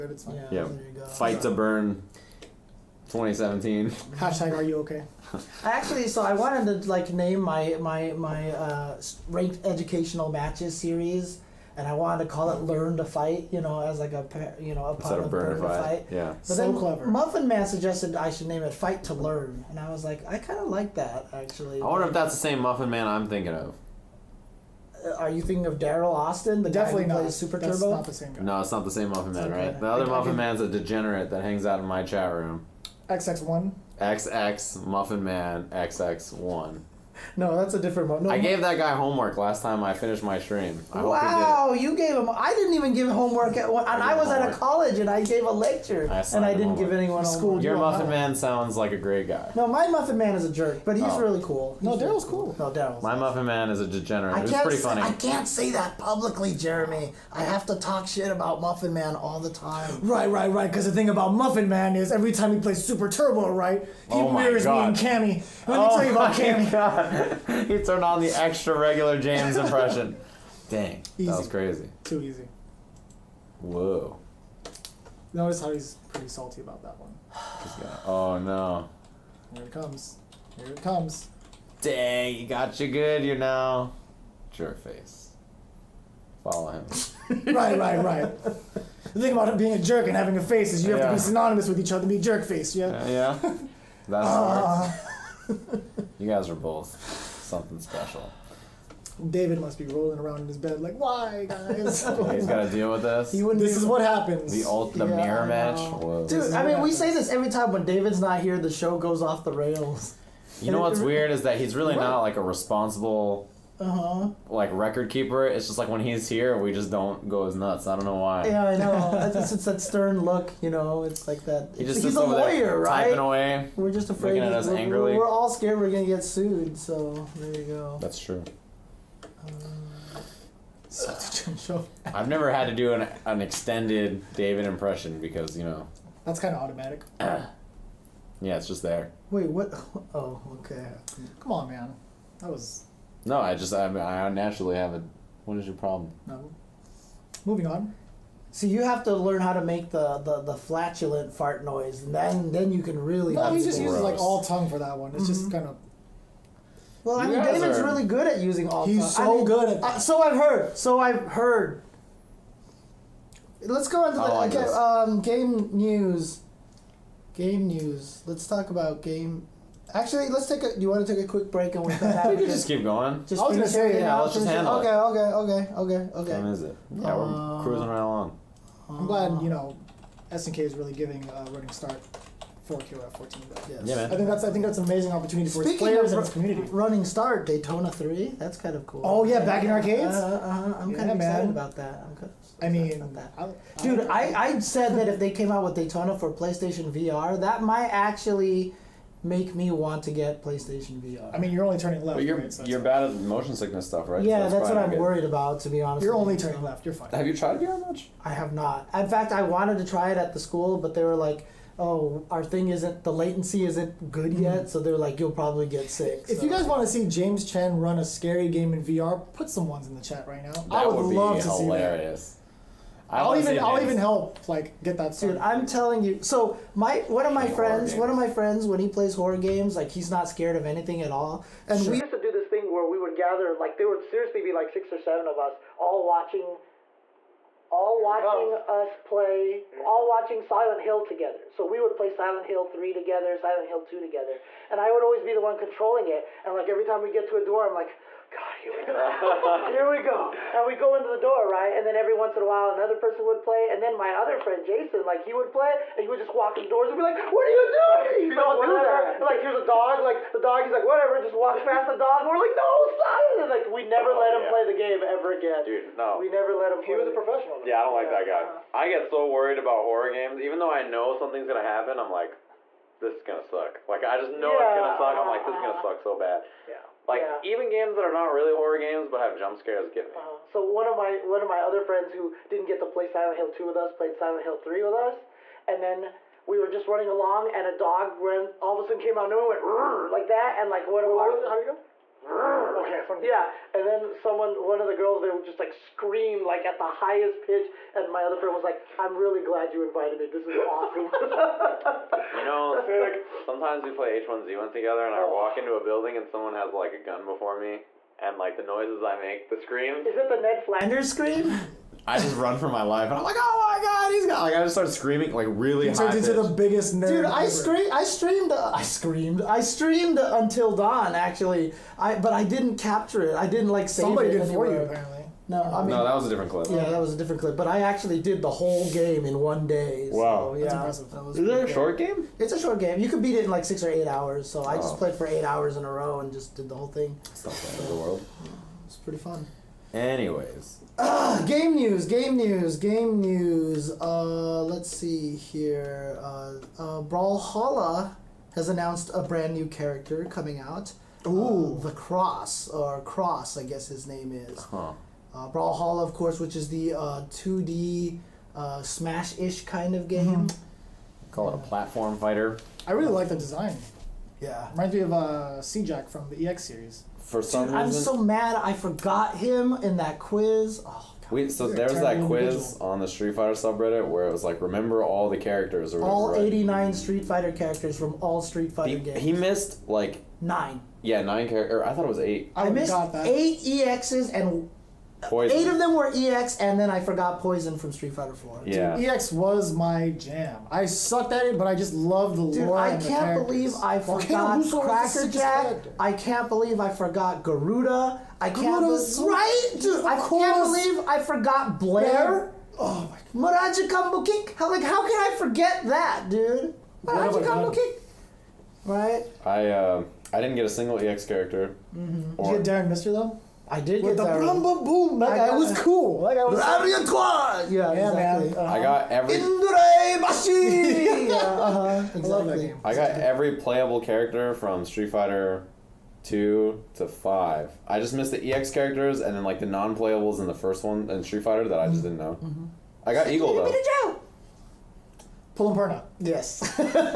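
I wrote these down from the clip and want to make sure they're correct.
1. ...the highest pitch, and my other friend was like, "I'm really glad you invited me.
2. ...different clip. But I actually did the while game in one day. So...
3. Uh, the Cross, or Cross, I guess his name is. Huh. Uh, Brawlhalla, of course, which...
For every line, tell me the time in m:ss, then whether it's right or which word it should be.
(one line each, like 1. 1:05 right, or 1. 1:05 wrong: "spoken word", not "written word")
1. 4:56 right
2. 5:27 wrong: "whole", not "while"
3. 5:51 right.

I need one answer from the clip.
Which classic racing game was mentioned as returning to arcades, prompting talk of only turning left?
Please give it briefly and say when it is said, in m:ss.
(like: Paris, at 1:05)
Daytona 3, at 3:07.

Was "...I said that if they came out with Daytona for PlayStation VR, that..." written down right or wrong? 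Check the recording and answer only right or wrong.
right.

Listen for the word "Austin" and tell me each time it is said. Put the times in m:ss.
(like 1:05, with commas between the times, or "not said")
0:26.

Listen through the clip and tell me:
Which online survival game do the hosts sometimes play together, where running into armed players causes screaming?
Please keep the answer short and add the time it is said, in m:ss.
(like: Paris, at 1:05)
H1Z1, at 5:04.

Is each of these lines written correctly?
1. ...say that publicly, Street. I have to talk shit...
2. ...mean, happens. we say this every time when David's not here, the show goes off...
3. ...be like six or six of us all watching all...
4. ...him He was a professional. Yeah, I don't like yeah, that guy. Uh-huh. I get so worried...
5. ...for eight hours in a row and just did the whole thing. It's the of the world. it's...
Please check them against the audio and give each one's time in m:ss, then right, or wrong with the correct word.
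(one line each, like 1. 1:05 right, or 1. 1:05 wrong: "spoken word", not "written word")
1. 0:55 wrong: "Jeremy", not "Street"
2. 1:46 right
3. 3:54 wrong: "seven", not "six"
4. 4:26 right
5. 5:35 right.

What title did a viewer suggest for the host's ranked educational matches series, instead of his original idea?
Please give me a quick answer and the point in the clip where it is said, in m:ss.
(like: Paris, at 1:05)
Fight to Learn, at 0:18.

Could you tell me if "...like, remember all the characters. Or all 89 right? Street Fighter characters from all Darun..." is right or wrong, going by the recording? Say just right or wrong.
wrong.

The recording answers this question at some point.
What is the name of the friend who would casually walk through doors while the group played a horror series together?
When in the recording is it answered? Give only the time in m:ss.
4:14.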